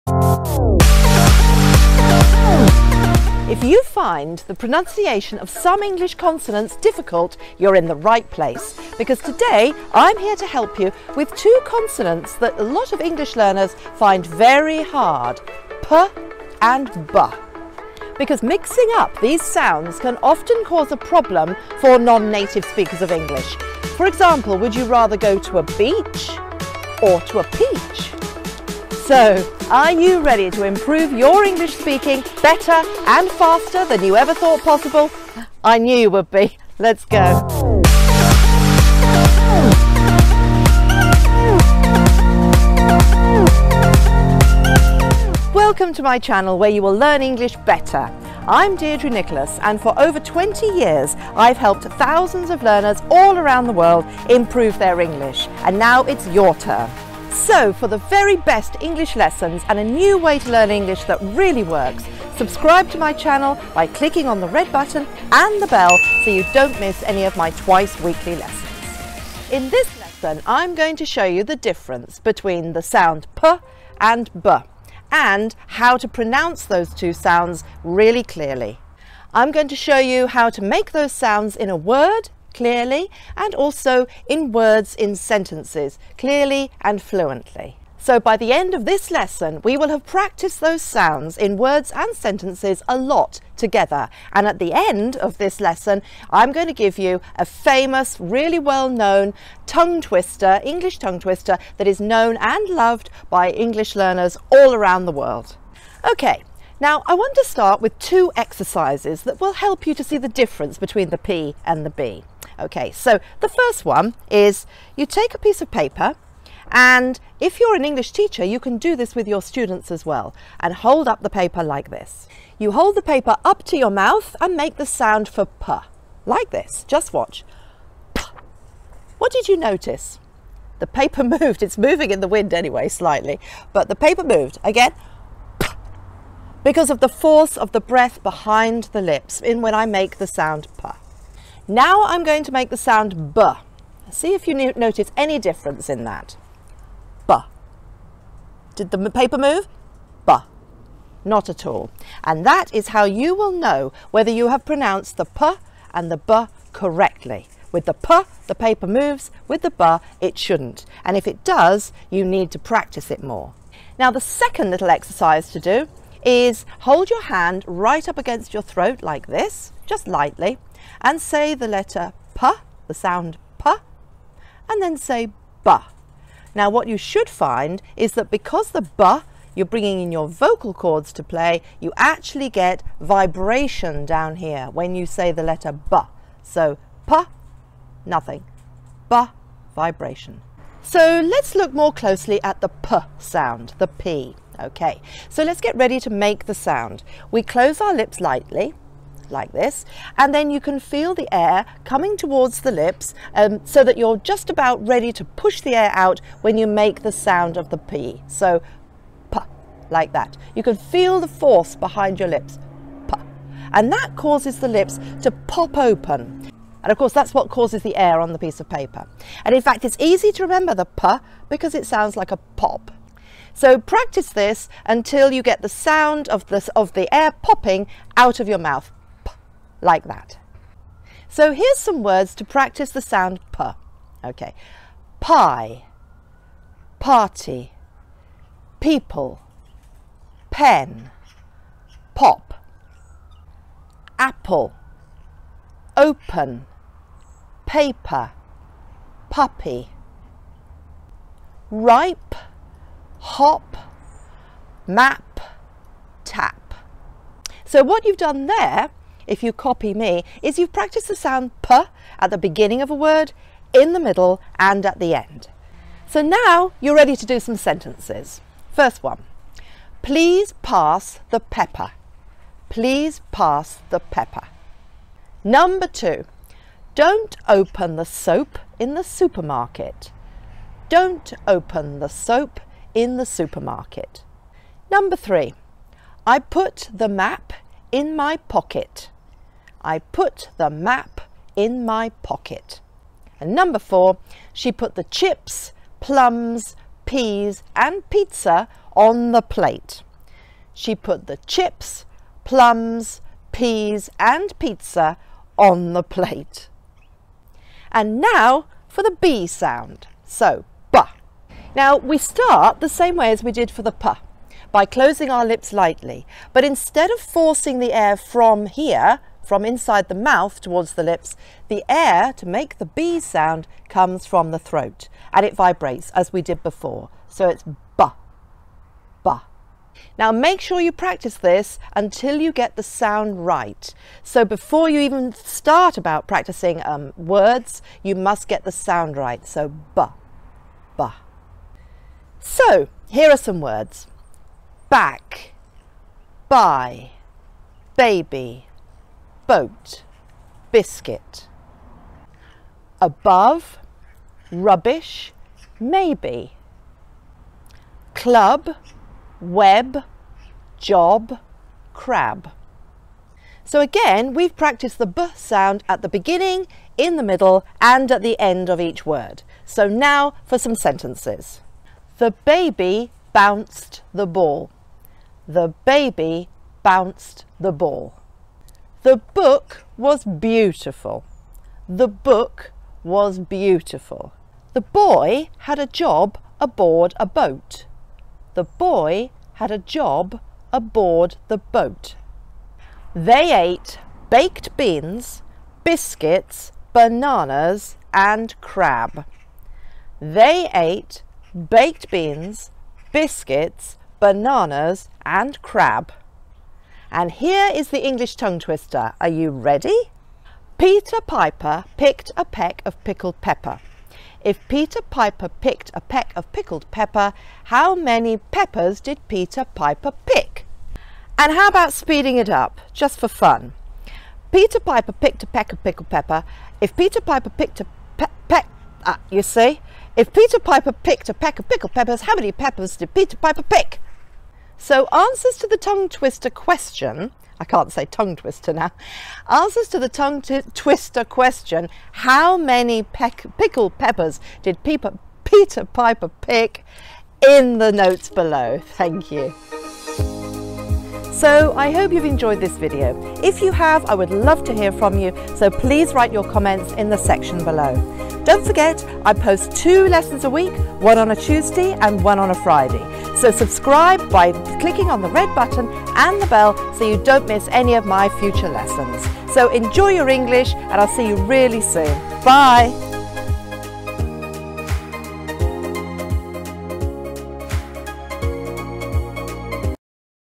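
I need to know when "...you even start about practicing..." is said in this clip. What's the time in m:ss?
5:34.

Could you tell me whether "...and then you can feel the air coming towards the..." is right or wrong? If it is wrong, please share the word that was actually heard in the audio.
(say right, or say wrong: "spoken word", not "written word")
right.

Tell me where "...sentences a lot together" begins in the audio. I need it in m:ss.
1:32.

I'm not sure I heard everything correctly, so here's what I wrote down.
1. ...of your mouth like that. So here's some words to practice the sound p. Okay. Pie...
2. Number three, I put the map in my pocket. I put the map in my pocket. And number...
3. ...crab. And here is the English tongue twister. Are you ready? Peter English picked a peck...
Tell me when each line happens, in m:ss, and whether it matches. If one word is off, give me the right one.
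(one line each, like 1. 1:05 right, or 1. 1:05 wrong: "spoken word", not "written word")
1. 3:48 right
2. 4:44 right
3. 6:45 wrong: "Piper", not "English".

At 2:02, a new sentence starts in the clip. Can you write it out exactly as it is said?
You hold the paper up to your mouth and make the sound for p, like this.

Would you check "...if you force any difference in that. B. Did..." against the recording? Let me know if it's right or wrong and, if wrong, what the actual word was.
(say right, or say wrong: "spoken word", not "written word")
wrong: "notice", not "force".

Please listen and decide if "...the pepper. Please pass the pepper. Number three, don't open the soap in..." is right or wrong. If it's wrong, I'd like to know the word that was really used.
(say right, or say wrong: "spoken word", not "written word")
wrong: "two", not "three".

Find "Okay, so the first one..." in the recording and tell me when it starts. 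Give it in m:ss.
1:52.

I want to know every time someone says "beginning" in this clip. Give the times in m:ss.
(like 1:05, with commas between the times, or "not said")
4:22, 6:06.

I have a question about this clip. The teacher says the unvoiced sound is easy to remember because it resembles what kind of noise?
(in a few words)
a pop.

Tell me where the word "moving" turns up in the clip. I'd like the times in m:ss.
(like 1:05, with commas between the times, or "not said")
2:11.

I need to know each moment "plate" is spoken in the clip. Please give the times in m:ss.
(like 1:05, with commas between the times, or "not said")
4:59, 5:06.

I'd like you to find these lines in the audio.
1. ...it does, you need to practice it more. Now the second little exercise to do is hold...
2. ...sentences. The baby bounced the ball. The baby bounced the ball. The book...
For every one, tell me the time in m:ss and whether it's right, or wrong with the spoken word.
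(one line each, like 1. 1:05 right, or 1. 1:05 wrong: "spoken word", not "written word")
1. 2:41 right
2. 6:10 right.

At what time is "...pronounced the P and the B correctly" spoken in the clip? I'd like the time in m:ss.
2:34.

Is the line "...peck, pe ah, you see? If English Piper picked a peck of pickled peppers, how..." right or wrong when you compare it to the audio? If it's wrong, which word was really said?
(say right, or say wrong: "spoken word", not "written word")
wrong: "Peter", not "English".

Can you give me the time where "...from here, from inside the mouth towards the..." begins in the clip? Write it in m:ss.
5:18.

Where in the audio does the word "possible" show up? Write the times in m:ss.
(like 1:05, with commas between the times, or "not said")
0:34.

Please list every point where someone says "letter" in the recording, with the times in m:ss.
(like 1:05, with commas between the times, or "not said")
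2:51, 3:05.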